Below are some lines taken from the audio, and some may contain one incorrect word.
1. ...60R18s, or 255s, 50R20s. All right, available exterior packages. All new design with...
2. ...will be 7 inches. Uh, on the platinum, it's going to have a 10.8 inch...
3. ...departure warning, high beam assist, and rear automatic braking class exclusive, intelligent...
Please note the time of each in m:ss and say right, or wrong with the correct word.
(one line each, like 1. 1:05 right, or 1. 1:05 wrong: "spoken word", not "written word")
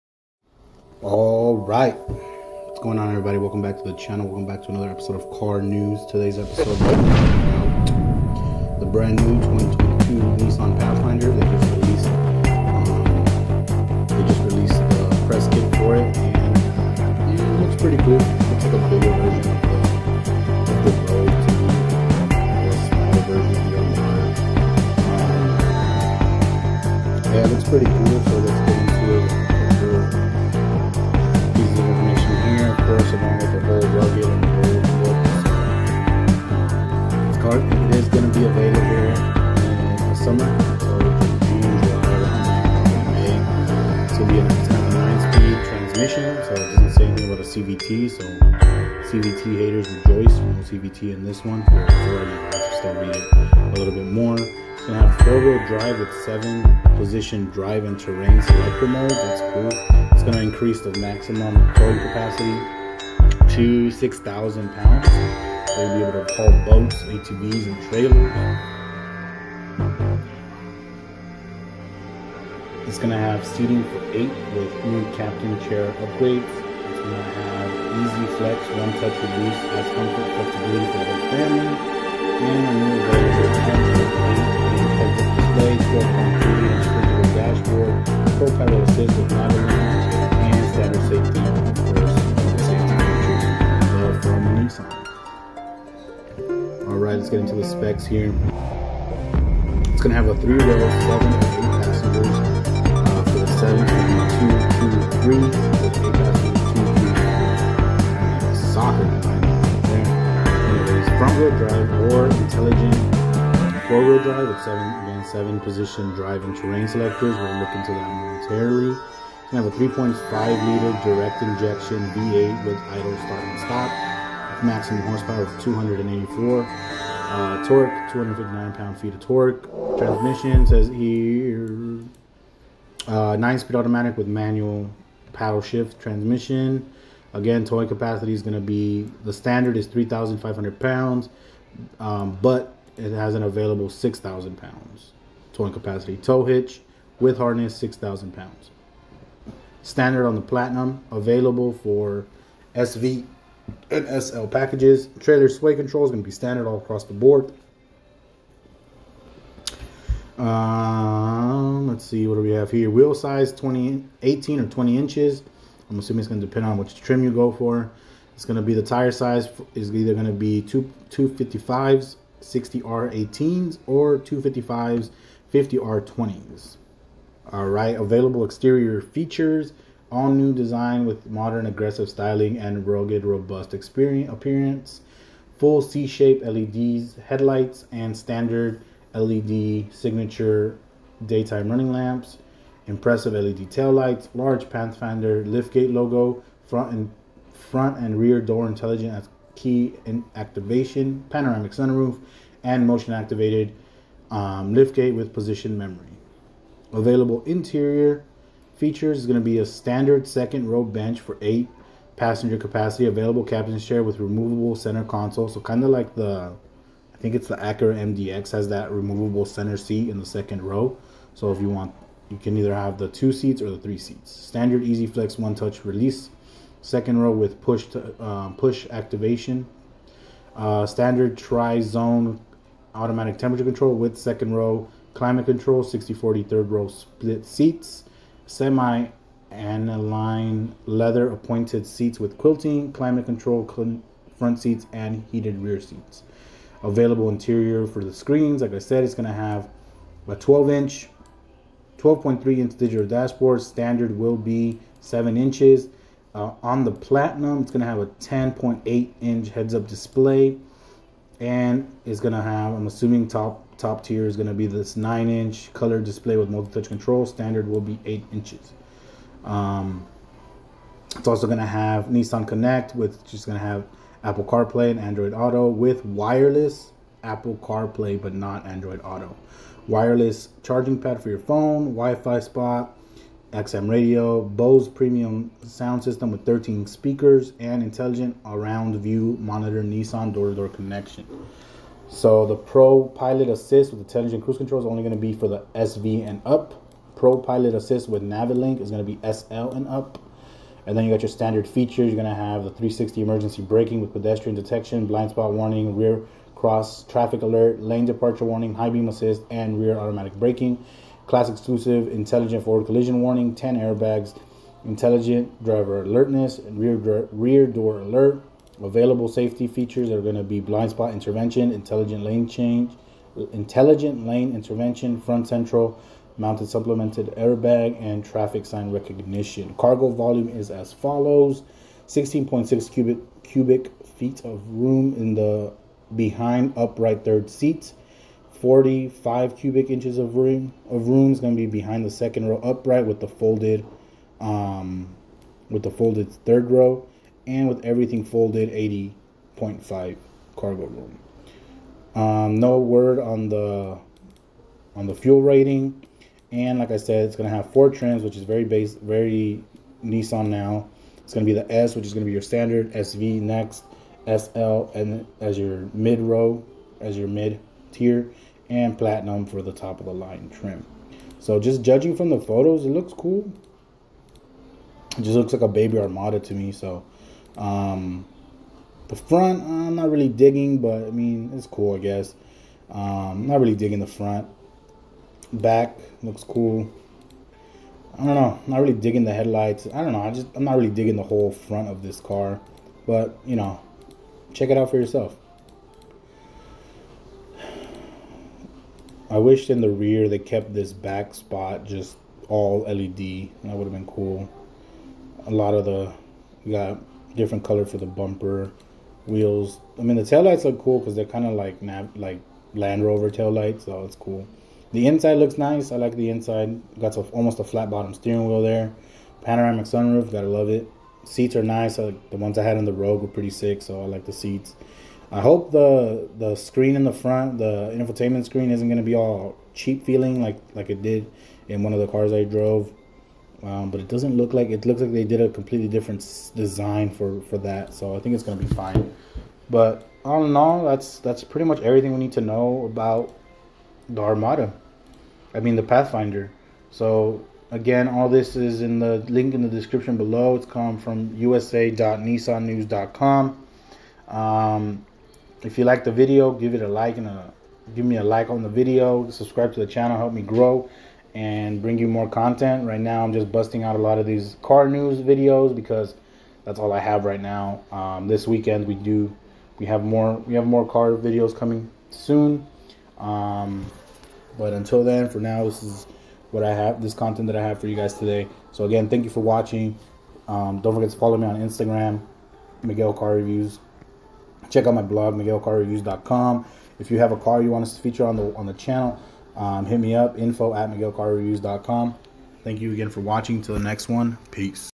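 1. 2:52 wrong: "features", not "packages"
2. 4:14 right
3. 5:08 right.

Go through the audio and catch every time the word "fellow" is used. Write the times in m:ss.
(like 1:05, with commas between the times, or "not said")
not said.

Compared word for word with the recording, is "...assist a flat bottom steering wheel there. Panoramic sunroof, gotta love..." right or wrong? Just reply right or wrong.
wrong.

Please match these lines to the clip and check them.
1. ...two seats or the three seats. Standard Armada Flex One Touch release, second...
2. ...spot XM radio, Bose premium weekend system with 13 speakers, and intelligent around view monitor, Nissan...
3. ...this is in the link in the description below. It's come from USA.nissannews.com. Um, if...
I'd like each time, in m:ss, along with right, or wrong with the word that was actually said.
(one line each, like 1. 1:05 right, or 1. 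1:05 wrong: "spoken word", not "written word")
1. 3:43 wrong: "Easy", not "Armada"
2. 4:42 wrong: "sound", not "weekend"
3. 7:28 right.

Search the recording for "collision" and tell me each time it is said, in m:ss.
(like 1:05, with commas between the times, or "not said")
5:12.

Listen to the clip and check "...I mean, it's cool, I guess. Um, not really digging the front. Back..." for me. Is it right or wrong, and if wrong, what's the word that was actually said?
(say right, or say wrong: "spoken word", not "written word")
right.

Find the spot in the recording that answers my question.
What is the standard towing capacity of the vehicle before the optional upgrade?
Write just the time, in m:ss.
2:19.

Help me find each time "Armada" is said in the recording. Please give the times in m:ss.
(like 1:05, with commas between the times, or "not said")
6:15, 7:24.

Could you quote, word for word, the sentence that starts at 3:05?
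Full C shape LEDs, headlights, and standard LED signature daytime running lamps.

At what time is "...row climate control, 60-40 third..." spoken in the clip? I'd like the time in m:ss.
3:54.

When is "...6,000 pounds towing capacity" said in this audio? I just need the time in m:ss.
2:23.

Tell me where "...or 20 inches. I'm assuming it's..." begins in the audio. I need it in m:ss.
2:44.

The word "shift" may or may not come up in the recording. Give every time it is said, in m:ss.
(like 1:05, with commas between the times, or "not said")
2:15.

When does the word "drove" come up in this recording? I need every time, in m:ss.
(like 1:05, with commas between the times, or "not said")
7:12.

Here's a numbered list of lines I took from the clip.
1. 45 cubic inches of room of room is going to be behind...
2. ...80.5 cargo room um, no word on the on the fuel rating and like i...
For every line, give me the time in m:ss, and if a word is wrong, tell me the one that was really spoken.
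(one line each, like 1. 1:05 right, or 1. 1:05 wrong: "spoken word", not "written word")
1. 5:38 right
2. 5:48 right.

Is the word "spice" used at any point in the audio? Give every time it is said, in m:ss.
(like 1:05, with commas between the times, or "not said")
not said.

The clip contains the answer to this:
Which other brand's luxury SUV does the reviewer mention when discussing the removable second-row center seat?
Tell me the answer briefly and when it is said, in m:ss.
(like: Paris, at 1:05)
Acura MDX, at 3:37.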